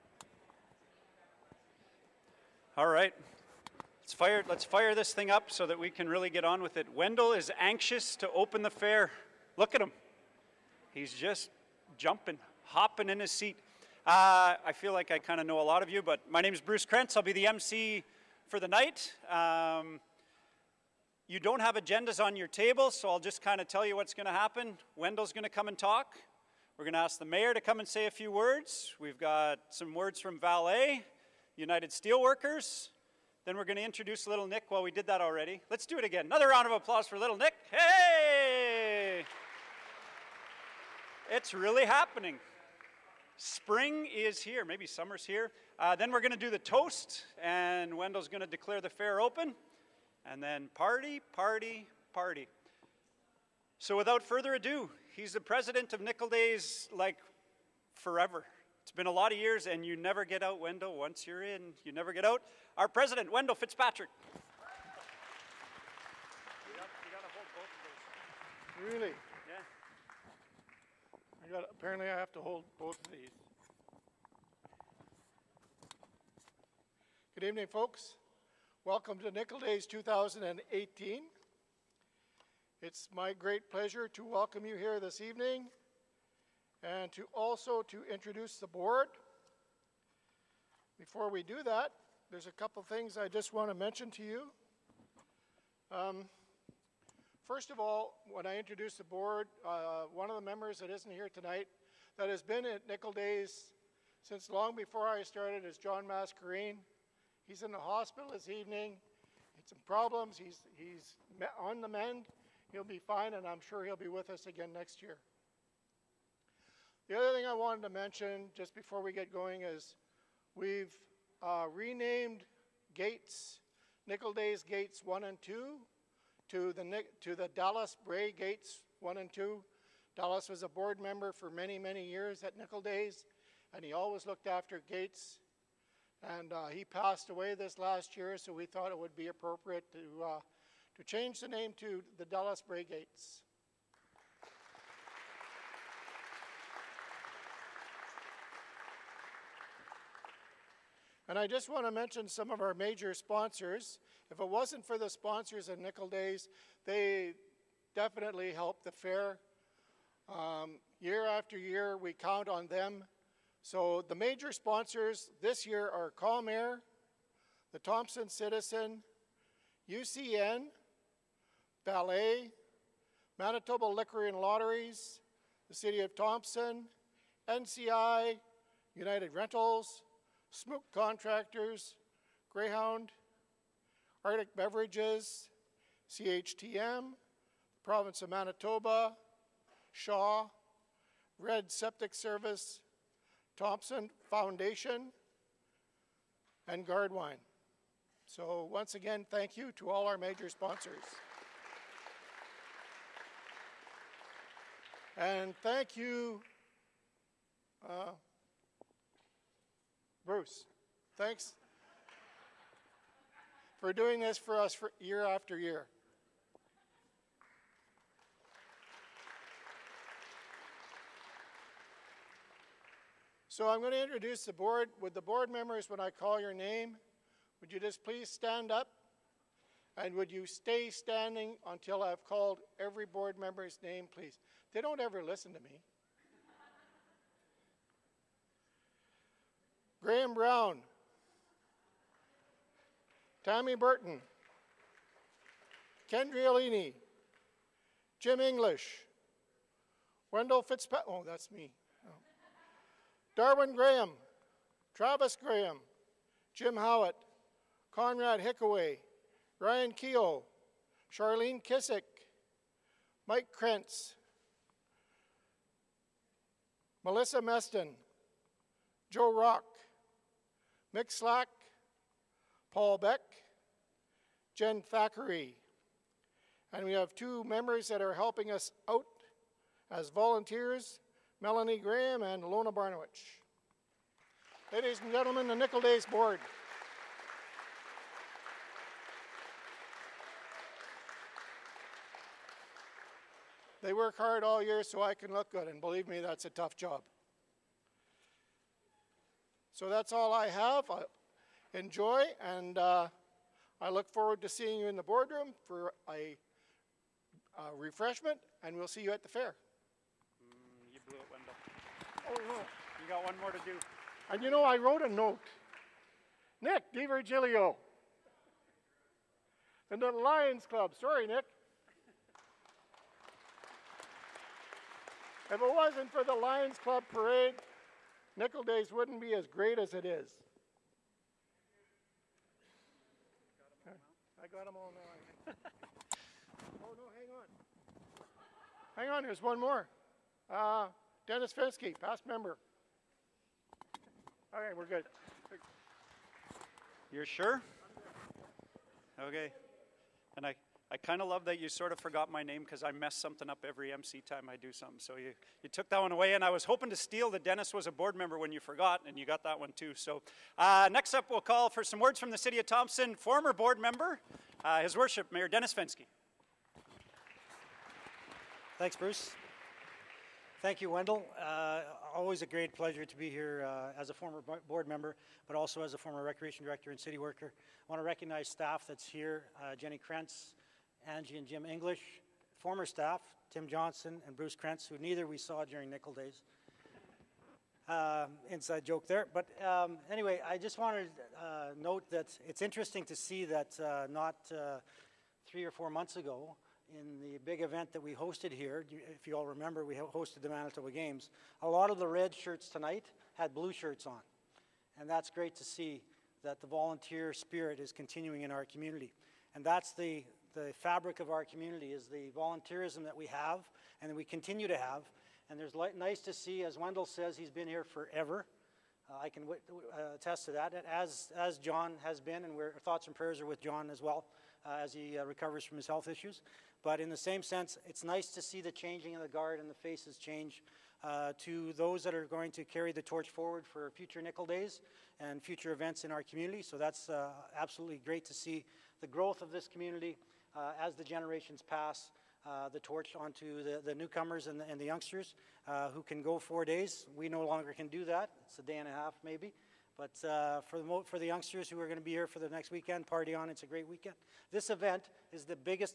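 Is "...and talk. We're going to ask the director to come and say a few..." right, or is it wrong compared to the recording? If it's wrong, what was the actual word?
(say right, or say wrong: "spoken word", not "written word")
wrong: "mayor", not "director".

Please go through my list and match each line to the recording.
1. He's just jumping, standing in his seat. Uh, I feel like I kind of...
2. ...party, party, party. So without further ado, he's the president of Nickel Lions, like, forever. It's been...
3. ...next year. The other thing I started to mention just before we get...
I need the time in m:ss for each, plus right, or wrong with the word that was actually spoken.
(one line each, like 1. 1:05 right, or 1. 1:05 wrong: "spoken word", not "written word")
1. 0:10 wrong: "hopping", not "standing"
2. 0:50 wrong: "Days", not "Lions"
3. 1:54 wrong: "wanted", not "started".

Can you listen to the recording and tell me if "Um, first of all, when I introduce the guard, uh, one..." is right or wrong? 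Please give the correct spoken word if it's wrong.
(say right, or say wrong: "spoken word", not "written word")
wrong: "board", not "guard".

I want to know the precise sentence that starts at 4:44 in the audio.
Ladies and gentlemen, the Nickel Days Board.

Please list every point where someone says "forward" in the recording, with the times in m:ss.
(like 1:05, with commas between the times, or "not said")
5:04, 7:13.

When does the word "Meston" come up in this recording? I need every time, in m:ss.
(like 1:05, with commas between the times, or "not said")
4:27.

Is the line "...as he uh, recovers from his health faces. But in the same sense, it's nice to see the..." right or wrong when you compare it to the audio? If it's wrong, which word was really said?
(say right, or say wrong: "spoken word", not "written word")
wrong: "issues", not "faces".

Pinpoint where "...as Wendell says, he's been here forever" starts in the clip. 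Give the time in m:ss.
6:56.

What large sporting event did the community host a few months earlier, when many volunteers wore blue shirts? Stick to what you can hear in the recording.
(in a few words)
Manitoba Games.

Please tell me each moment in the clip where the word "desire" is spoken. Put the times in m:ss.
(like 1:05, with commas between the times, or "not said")
not said.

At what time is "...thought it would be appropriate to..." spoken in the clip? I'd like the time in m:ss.
2:18.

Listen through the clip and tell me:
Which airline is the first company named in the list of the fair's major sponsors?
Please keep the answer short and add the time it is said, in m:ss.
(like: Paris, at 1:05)
Calm Air, at 2:46.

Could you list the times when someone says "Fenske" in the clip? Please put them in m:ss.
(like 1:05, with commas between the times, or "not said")
5:41, 6:05.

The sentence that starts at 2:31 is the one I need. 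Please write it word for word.
And I just want to mention some of our major sponsors.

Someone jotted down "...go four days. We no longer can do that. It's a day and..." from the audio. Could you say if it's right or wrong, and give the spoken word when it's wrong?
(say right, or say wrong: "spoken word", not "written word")
right.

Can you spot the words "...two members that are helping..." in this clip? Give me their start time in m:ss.
4:37.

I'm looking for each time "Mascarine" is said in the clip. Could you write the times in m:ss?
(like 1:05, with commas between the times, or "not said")
1:46.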